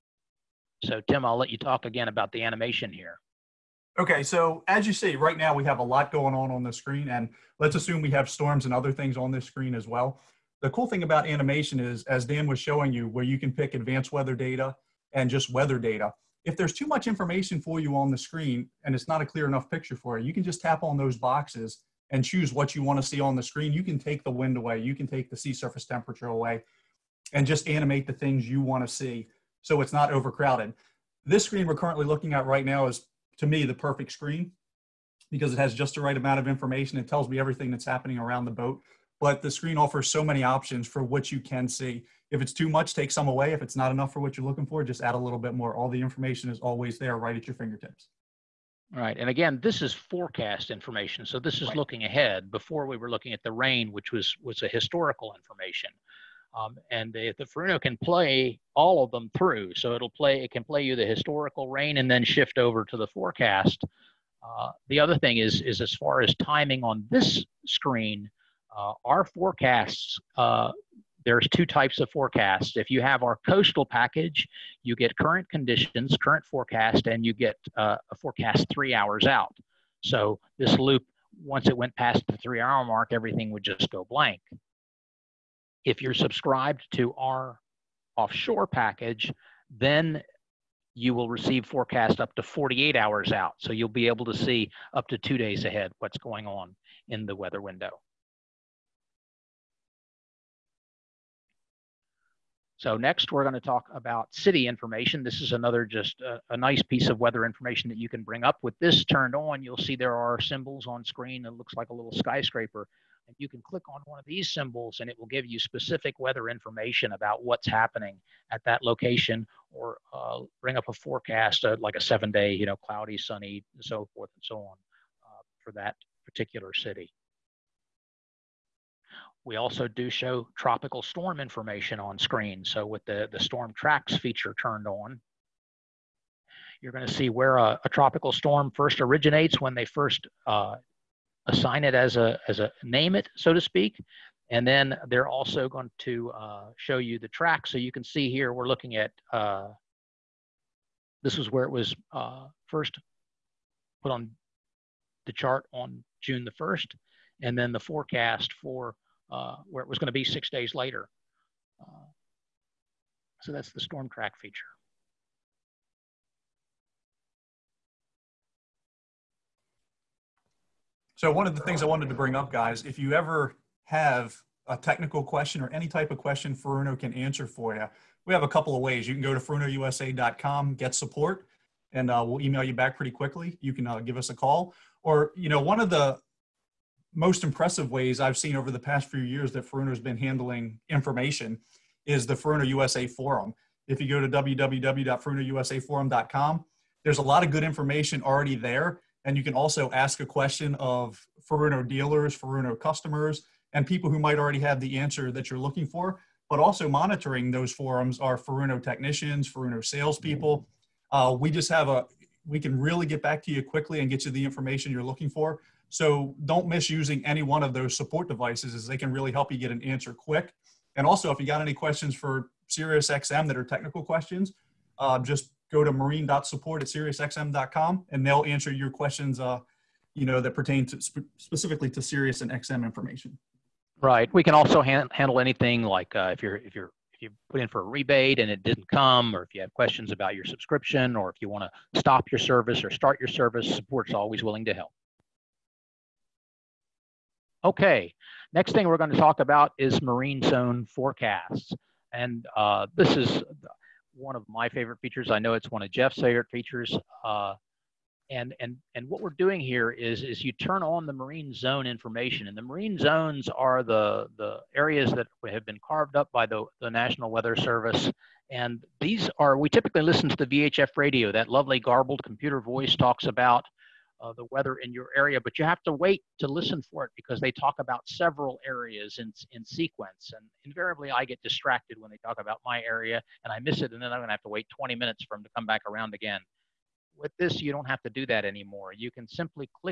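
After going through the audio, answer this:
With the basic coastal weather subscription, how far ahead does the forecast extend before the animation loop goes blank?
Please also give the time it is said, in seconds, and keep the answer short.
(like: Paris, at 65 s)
3 hours, at 78 s.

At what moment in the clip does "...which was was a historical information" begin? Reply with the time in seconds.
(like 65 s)
53 s.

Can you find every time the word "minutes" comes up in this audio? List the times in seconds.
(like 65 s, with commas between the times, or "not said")
284 s.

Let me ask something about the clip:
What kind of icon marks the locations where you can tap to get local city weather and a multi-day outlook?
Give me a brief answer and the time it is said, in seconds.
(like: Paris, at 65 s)
a little skyscraper, at 111 s.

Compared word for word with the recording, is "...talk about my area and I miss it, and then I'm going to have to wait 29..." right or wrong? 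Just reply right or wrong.
wrong.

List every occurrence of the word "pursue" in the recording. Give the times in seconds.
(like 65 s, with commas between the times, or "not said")
not said.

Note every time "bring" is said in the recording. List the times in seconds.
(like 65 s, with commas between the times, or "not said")
108 s, 120 s, 172 s.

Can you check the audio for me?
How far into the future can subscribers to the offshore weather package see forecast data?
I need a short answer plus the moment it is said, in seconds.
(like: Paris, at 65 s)
48 hours, at 92 s.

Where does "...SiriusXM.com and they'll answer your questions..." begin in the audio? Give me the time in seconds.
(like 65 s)
226 s.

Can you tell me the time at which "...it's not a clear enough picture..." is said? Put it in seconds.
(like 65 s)
18 s.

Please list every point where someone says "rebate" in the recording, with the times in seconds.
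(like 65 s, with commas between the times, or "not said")
237 s.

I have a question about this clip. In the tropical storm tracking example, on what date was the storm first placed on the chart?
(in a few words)
June 1st.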